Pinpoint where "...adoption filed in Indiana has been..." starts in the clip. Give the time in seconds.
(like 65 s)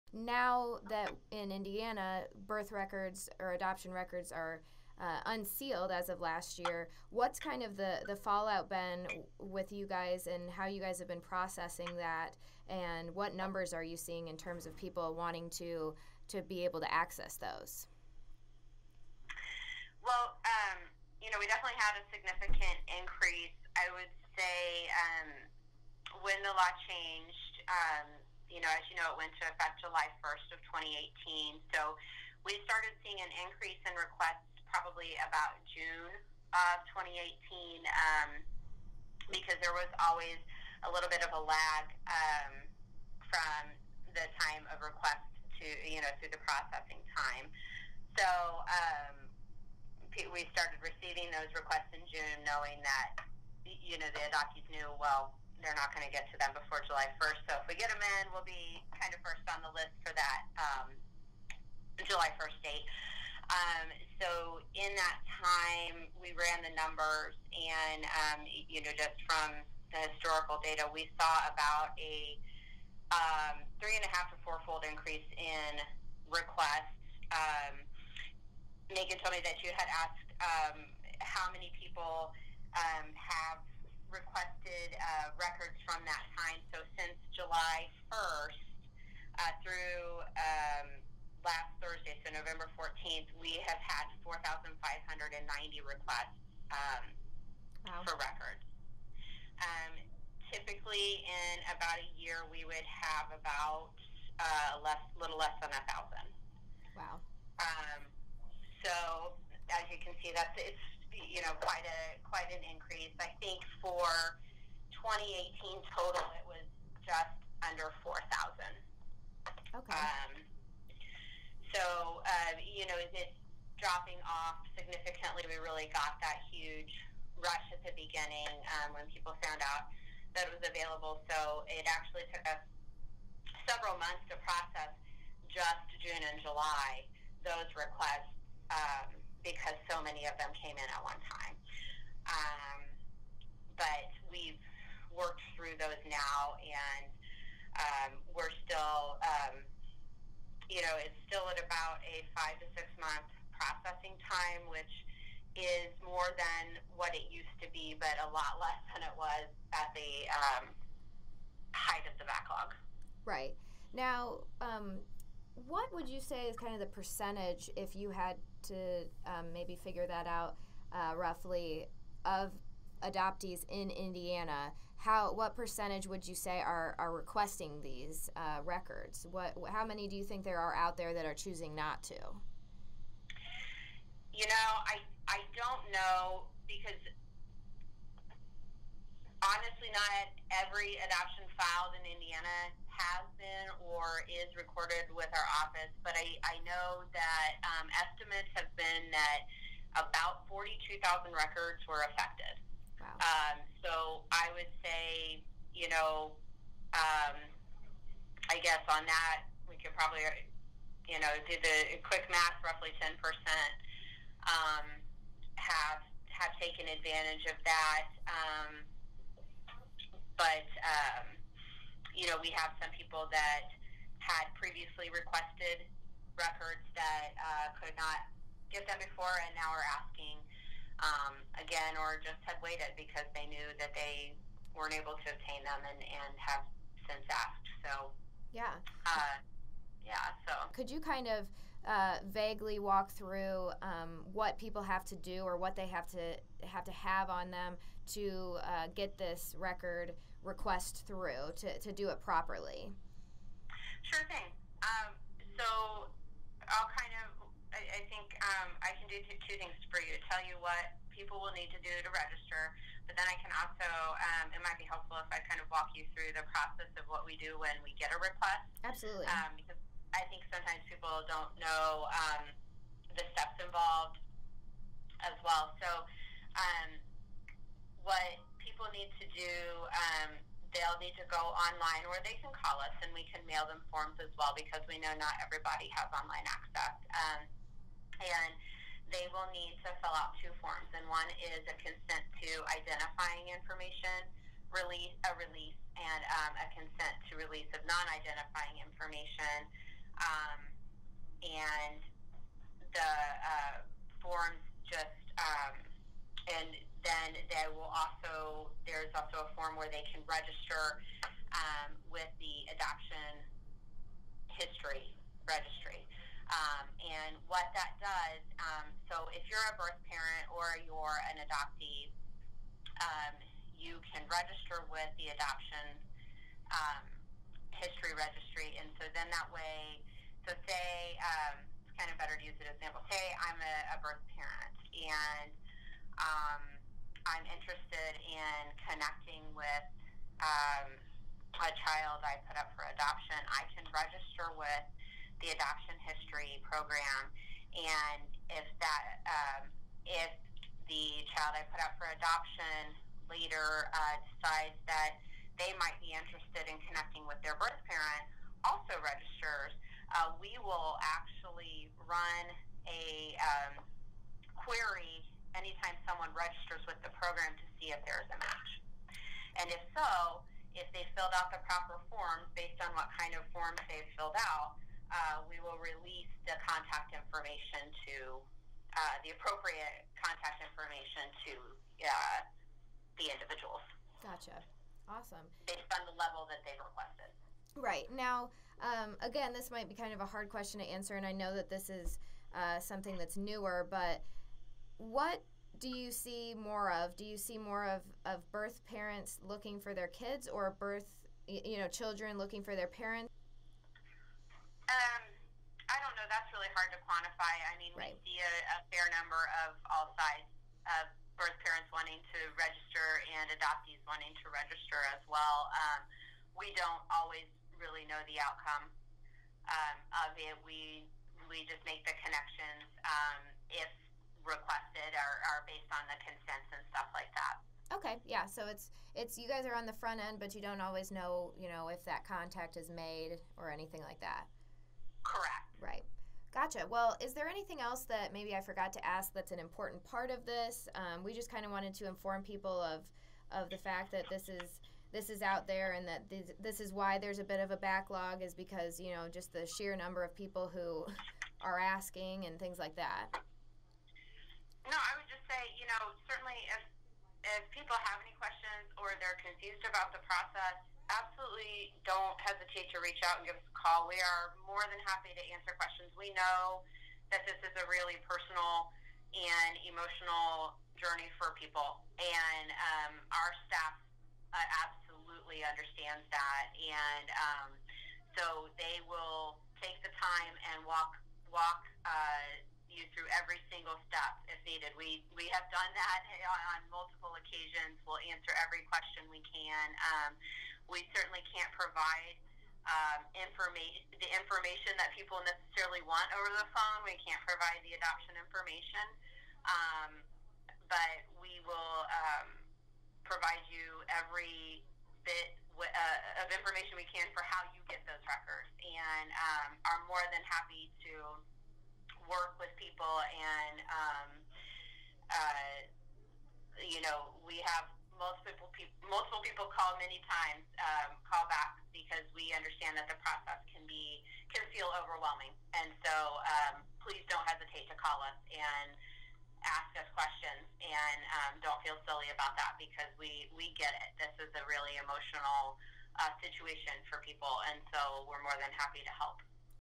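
191 s.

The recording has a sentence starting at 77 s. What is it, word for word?
Um, Megan told me that you had asked um, how many people um, have requested uh, records from that time.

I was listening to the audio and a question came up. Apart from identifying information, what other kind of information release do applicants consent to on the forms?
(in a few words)
non-identifying information.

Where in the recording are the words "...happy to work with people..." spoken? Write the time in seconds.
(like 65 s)
510 s.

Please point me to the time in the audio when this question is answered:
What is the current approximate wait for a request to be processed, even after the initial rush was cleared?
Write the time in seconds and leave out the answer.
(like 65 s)
152 s.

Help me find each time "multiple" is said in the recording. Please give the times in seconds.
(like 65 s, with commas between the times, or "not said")
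486 s, 519 s.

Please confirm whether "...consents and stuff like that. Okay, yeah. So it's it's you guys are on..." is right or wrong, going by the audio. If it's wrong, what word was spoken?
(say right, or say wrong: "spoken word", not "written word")
right.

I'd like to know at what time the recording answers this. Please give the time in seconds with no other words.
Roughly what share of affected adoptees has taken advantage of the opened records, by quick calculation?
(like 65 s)
213 s.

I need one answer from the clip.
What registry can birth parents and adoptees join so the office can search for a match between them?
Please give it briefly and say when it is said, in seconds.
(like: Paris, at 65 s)
adoption history registry, at 312 s.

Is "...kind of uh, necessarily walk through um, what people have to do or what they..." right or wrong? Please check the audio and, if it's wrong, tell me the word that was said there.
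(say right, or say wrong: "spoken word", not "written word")
wrong: "vaguely", not "necessarily".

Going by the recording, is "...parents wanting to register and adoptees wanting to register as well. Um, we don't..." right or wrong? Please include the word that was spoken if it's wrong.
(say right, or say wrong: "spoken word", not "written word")
right.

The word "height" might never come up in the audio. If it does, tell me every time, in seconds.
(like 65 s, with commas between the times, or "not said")
161 s.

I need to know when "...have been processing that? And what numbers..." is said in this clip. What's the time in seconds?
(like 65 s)
10 s.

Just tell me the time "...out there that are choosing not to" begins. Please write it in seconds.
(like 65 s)
180 s.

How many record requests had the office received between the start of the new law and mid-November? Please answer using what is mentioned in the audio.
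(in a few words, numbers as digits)
4,590.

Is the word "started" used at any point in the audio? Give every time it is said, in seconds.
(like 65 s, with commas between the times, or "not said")
32 s, 50 s.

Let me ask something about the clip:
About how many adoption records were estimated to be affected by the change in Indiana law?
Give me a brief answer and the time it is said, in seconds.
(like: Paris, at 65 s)
42,000, at 200 s.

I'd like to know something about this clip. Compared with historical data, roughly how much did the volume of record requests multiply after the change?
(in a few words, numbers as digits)
3.5 to 4 times.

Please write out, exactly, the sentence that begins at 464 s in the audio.
We are more than happy to answer questions.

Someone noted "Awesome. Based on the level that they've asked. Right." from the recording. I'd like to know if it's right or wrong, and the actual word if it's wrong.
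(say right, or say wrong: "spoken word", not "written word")
wrong: "requested", not "asked".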